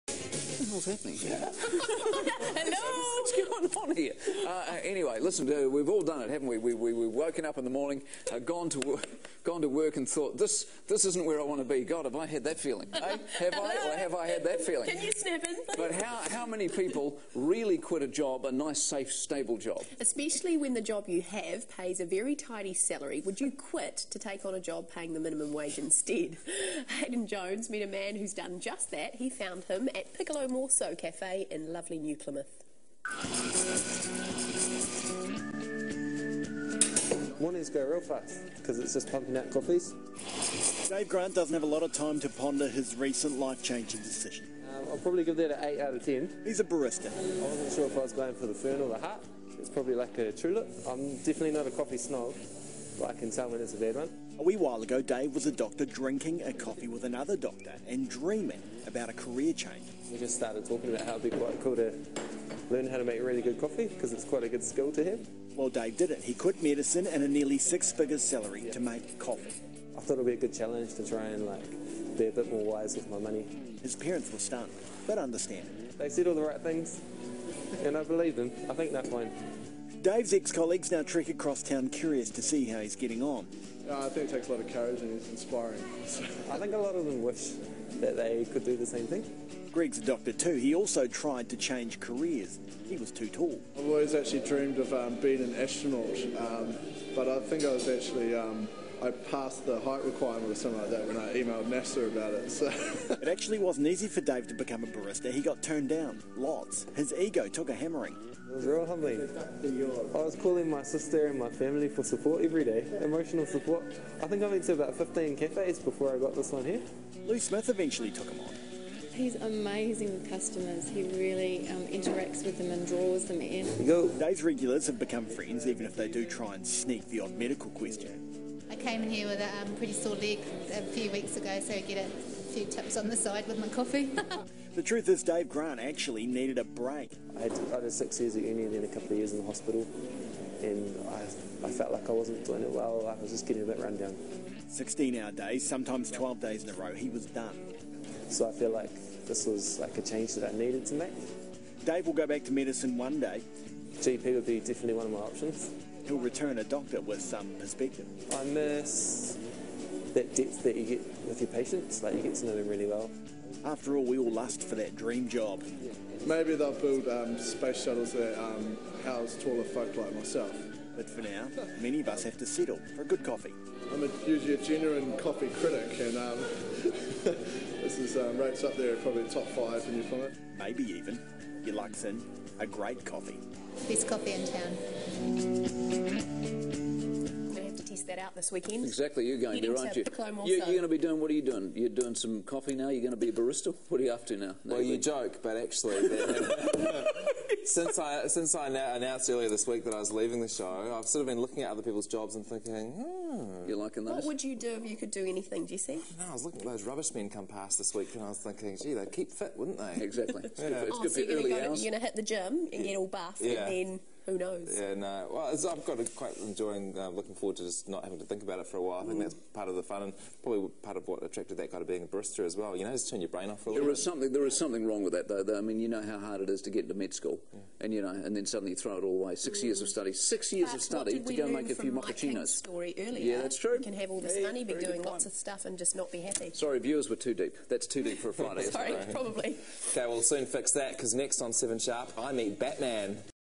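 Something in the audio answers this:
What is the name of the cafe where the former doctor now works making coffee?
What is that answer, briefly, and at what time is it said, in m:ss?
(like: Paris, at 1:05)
Piccolo Morso, at 0:30.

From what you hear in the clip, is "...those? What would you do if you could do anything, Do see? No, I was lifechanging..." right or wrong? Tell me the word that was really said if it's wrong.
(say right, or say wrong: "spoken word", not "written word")
wrong: "looking", not "lifechanging".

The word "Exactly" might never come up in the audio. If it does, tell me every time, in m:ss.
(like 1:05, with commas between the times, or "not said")
3:08, 3:30.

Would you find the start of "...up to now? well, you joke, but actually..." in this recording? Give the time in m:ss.
3:14.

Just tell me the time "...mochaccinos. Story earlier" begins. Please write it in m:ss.
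3:51.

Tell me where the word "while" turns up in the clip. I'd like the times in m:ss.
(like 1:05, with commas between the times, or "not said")
0:54, 3:38.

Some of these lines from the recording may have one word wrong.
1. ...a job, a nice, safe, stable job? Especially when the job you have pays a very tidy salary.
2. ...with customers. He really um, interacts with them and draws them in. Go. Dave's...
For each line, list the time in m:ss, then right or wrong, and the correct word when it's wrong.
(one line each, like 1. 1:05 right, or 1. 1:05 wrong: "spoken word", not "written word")
1. 0:18 right
2. 2:00 right.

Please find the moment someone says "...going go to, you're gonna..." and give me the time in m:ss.
3:31.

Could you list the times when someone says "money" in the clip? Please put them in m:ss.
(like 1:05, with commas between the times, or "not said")
1:13, 3:54.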